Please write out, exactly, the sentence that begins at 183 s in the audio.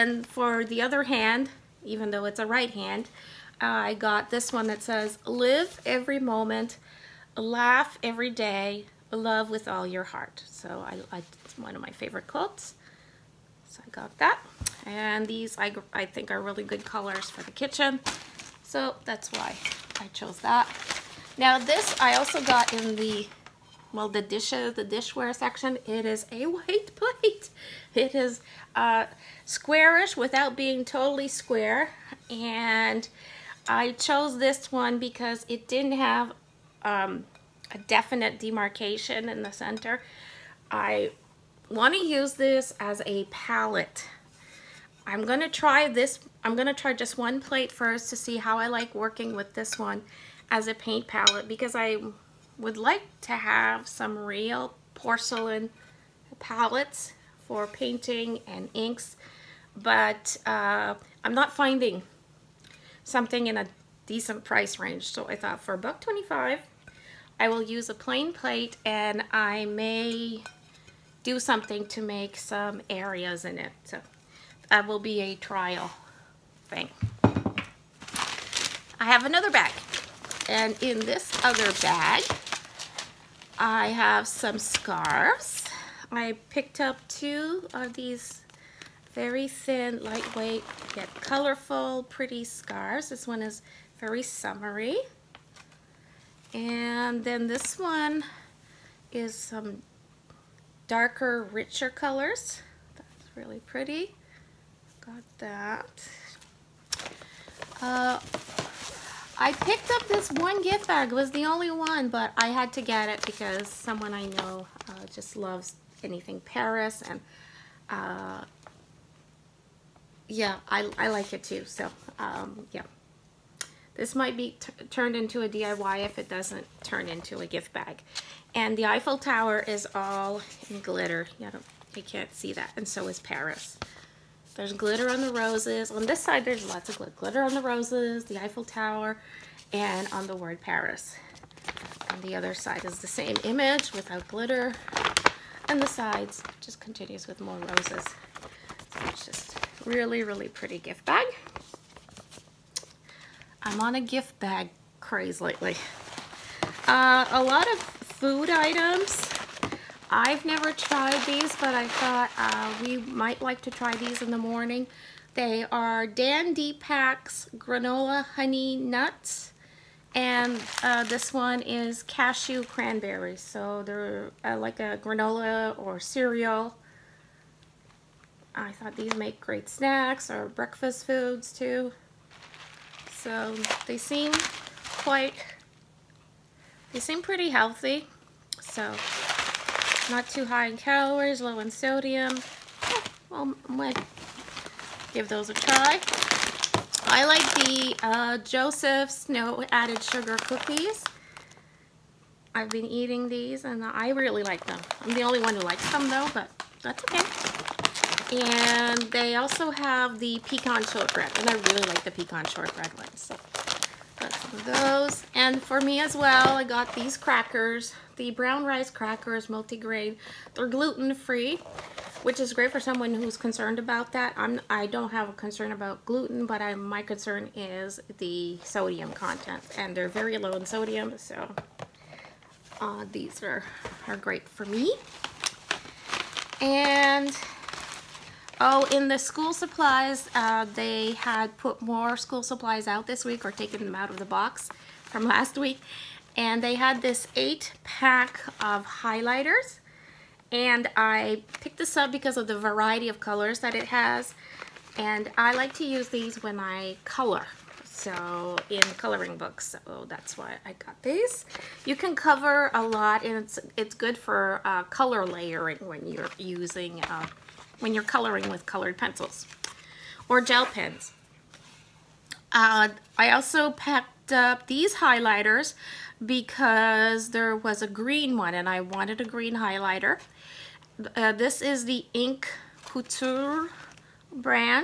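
So they seem quite, they seem pretty healthy.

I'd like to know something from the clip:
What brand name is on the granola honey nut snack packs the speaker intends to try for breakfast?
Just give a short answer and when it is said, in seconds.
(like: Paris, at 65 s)
Dandy Packs, at 166 s.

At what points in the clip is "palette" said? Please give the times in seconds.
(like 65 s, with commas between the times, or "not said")
43 s, 51 s, 56 s.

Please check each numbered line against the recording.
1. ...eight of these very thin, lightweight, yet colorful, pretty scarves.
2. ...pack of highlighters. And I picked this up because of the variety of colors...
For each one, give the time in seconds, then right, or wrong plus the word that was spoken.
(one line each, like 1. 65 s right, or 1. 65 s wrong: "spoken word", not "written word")
1. 87 s wrong: "two", not "eight"
2. 247 s right.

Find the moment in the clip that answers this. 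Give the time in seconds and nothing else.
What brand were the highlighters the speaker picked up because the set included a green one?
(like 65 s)
282 s.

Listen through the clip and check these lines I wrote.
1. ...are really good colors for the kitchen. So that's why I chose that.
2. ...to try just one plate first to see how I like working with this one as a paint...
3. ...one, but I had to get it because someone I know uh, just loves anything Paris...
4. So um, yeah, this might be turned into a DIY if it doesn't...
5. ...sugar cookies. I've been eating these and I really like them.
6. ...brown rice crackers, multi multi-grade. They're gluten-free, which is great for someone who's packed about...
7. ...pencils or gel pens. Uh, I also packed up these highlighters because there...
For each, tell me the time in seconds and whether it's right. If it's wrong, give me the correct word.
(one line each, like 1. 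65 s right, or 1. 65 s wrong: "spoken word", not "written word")
1. 16 s right
2. 46 s right
3. 111 s right
4. 121 s right
5. 200 s right
6. 218 s wrong: "concerned", not "packed"
7. 268 s right.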